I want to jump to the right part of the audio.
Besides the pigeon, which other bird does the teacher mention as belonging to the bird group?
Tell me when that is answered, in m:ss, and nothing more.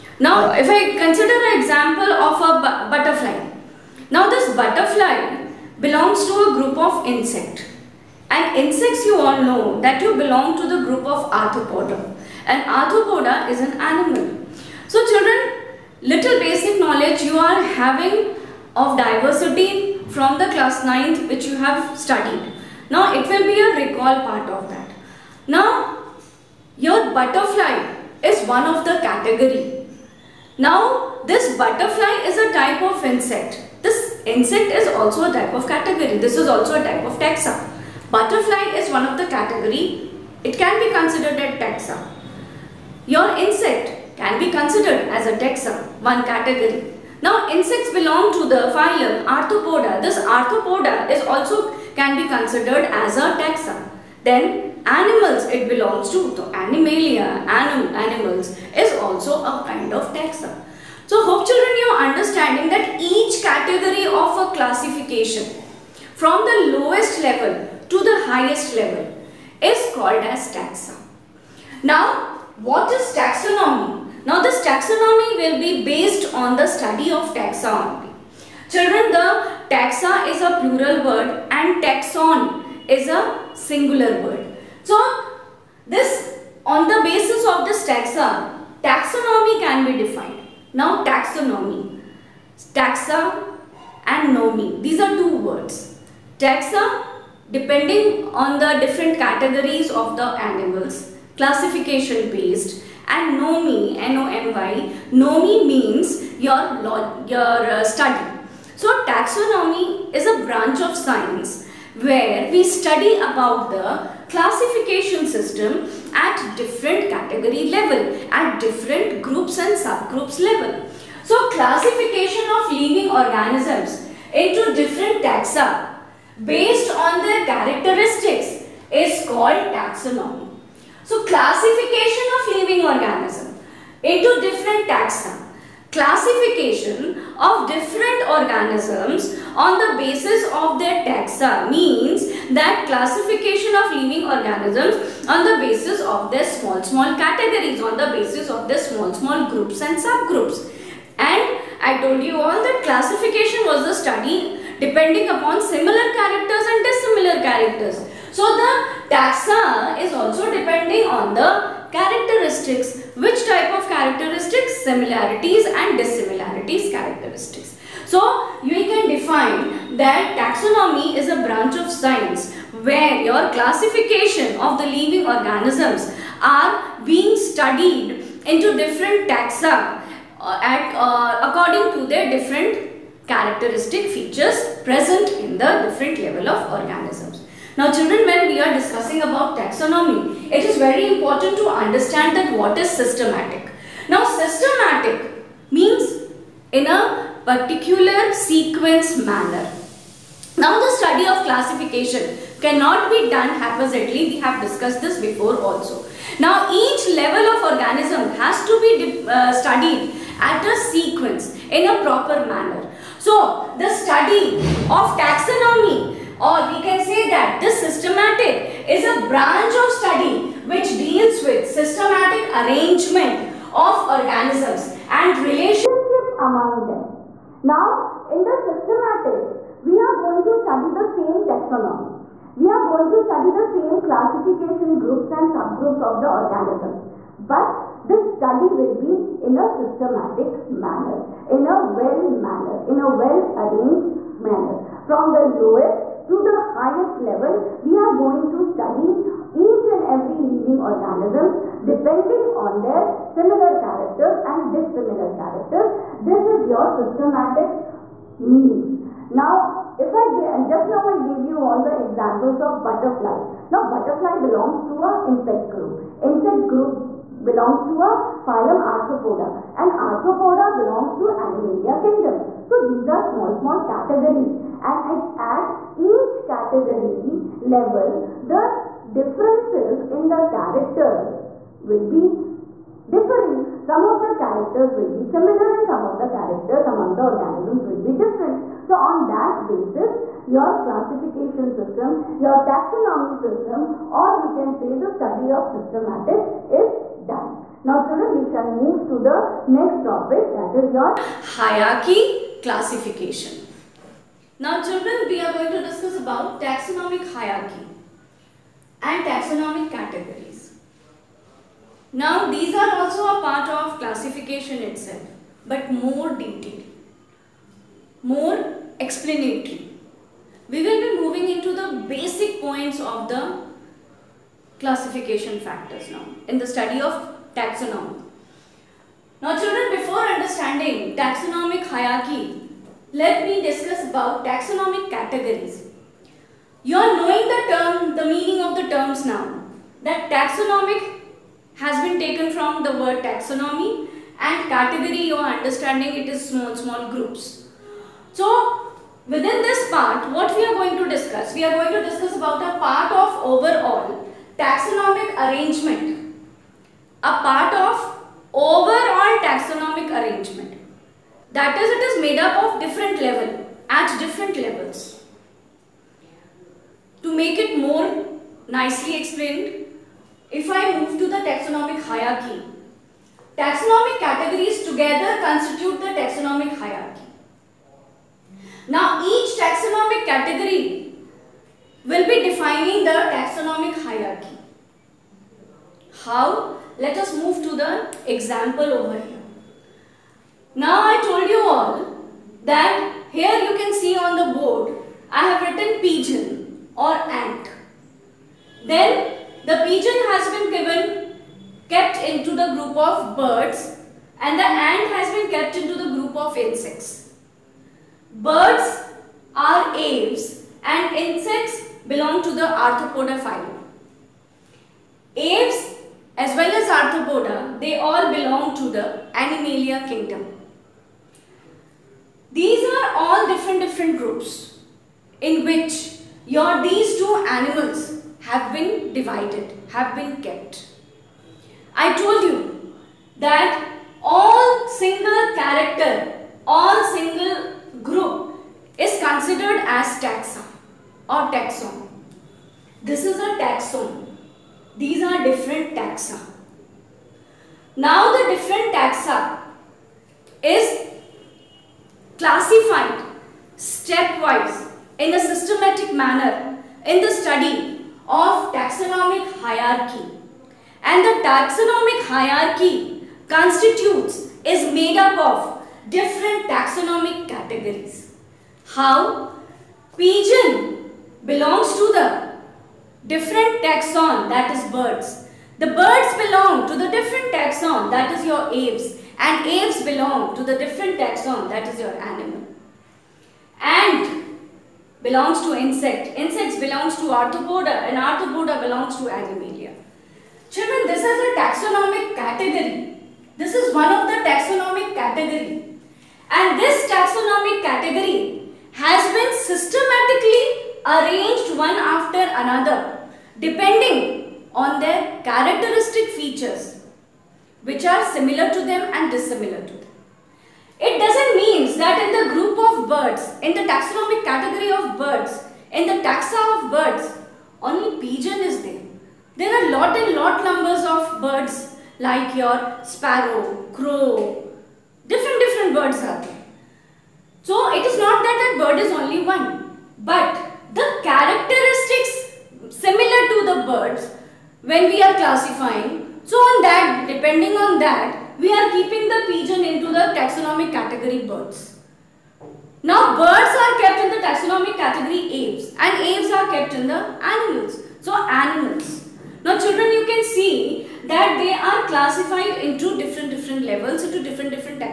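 8:43.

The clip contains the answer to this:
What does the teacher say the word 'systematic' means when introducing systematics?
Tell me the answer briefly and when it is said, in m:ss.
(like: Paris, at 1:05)
in a particular sequence, at 3:16.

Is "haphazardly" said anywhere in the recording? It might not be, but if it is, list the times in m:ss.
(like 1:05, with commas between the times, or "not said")
3:23.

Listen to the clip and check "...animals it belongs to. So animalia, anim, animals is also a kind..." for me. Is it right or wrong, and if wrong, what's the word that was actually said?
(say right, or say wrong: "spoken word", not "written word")
right.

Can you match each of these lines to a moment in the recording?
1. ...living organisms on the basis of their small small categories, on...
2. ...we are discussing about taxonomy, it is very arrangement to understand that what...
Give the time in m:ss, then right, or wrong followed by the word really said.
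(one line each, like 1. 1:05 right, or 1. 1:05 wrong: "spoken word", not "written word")
1. 2:23 right
2. 3:08 wrong: "important", not "arrangement".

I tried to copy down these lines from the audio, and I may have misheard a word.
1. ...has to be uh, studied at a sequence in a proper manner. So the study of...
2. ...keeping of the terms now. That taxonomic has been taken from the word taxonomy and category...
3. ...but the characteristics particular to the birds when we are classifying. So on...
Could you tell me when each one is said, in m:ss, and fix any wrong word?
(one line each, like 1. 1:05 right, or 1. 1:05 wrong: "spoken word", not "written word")
1. 3:28 right
2. 5:38 wrong: "meaning", not "keeping"
3. 8:50 wrong: "similar", not "particular".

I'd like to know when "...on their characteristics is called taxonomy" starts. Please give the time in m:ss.
2:06.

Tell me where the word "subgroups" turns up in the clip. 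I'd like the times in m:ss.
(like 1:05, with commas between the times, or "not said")
1:59, 2:29, 3:55.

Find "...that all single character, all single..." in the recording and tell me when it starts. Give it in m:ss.
7:13.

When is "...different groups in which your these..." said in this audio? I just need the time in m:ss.
7:03.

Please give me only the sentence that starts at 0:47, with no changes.
Now insects belong to the phylum Arthropoda.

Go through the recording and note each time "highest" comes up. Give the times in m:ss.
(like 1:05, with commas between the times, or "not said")
1:08, 4:06.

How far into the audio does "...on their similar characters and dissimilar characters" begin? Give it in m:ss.
4:12.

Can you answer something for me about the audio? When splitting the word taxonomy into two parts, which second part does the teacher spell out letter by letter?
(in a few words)
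N-O-M-Y.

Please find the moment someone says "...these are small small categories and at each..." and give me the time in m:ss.
4:32.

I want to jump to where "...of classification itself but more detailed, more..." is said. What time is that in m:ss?
5:13.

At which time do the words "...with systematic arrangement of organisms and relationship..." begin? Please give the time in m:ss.
3:41.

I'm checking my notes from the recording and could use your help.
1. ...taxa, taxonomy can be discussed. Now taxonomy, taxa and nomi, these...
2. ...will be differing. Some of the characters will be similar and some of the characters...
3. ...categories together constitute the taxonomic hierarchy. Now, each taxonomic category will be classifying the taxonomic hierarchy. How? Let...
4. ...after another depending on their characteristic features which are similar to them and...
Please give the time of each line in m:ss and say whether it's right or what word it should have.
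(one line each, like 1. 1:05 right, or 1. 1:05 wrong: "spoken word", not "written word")
1. 1:27 wrong: "defined", not "discussed"
2. 4:41 right
3. 6:14 wrong: "defining", not "classifying"
4. 8:21 right.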